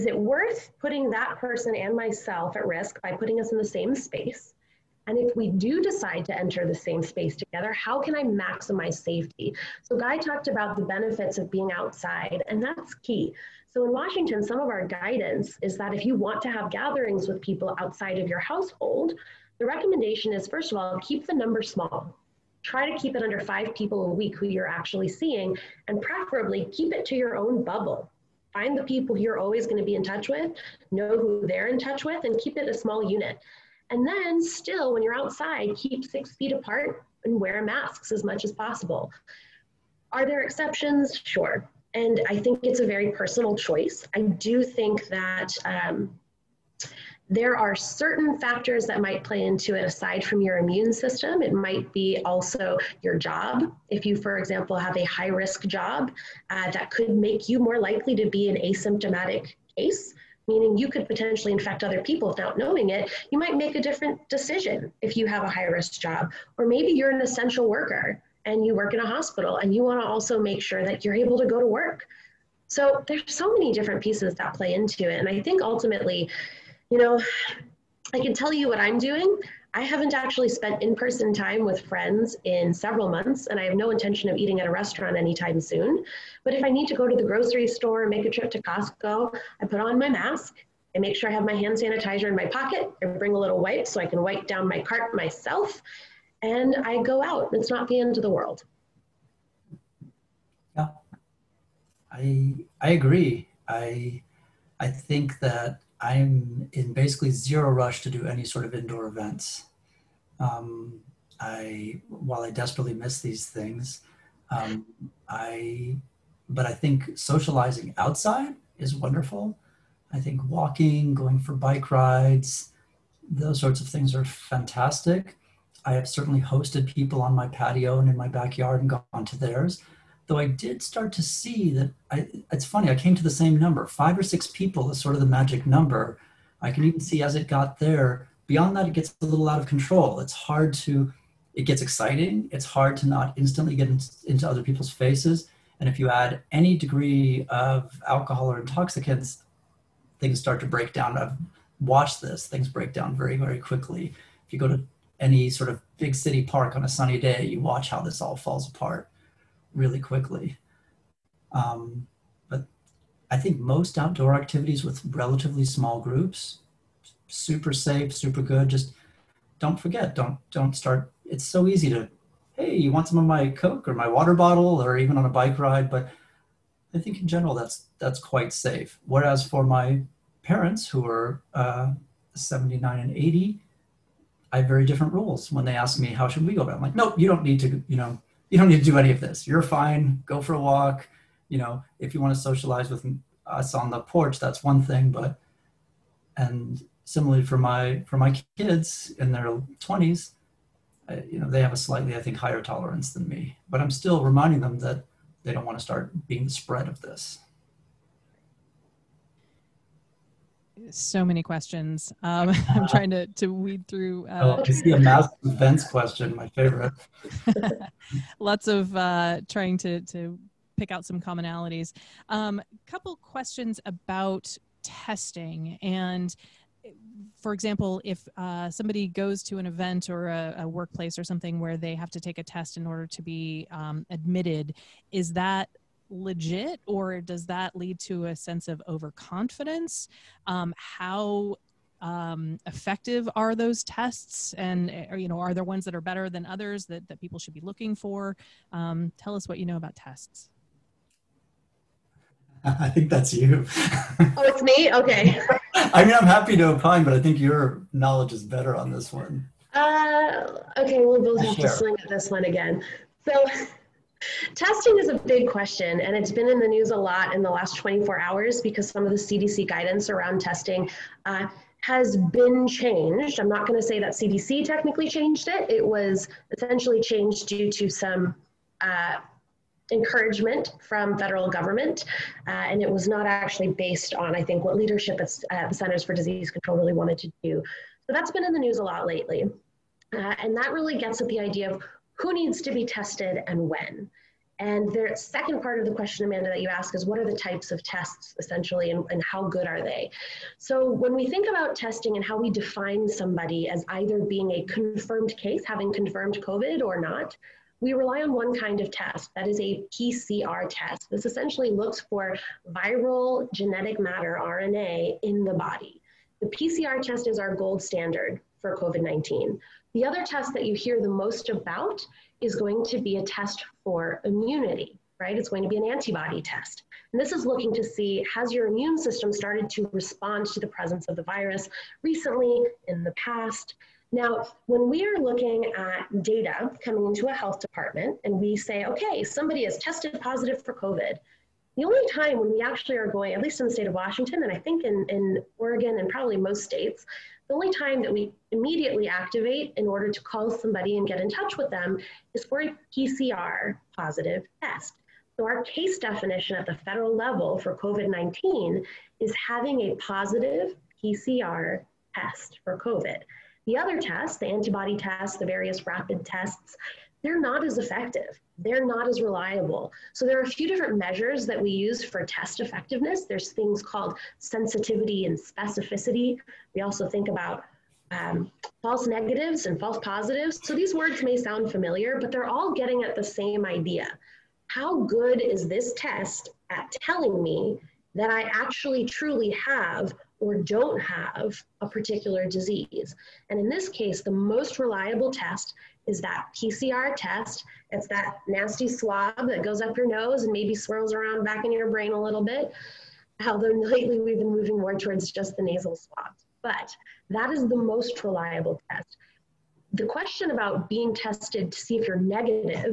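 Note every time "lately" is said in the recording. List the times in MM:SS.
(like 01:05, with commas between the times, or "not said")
04:49, 06:43.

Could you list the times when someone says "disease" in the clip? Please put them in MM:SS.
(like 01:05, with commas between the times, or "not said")
04:46, 06:32.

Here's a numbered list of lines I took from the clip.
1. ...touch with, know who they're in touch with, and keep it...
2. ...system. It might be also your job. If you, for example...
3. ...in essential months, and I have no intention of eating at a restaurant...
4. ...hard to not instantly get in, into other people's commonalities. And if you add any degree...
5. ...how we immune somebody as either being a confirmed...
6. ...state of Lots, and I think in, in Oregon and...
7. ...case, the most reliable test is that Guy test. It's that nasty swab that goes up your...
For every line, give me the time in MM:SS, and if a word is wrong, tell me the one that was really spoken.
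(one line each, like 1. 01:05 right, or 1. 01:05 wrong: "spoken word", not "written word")
1. 00:30 right
2. 00:50 right
3. 01:22 wrong: "several", not "essential"
4. 02:22 wrong: "faces", not "commonalities"
5. 05:02 wrong: "define", not "immune"
6. 05:43 wrong: "Washington", not "Lots"
7. 06:33 wrong: "PCR", not "Guy".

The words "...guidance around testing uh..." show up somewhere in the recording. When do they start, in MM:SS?
04:29.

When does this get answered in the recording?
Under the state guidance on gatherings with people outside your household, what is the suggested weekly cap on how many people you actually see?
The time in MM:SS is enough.
00:23.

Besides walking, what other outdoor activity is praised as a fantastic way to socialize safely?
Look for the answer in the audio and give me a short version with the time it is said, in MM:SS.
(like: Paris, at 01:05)
bike rides, at 02:01.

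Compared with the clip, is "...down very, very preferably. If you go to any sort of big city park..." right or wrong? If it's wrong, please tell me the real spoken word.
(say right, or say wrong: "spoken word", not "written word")
wrong: "quickly", not "preferably".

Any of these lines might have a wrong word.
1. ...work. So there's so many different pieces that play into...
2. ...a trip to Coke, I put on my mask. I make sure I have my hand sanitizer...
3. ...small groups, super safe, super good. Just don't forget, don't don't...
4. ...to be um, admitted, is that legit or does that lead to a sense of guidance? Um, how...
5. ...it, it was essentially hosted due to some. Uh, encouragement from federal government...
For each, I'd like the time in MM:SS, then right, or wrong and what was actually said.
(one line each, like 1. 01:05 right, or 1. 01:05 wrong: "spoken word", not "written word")
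1. 01:11 right
2. 01:28 wrong: "Costco", not "Coke"
3. 02:45 right
4. 03:53 wrong: "overconfidence", not "guidance"
5. 04:35 wrong: "changed", not "hosted".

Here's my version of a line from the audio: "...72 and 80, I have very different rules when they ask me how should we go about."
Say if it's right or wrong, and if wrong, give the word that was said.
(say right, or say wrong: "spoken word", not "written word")
wrong: "79", not "72".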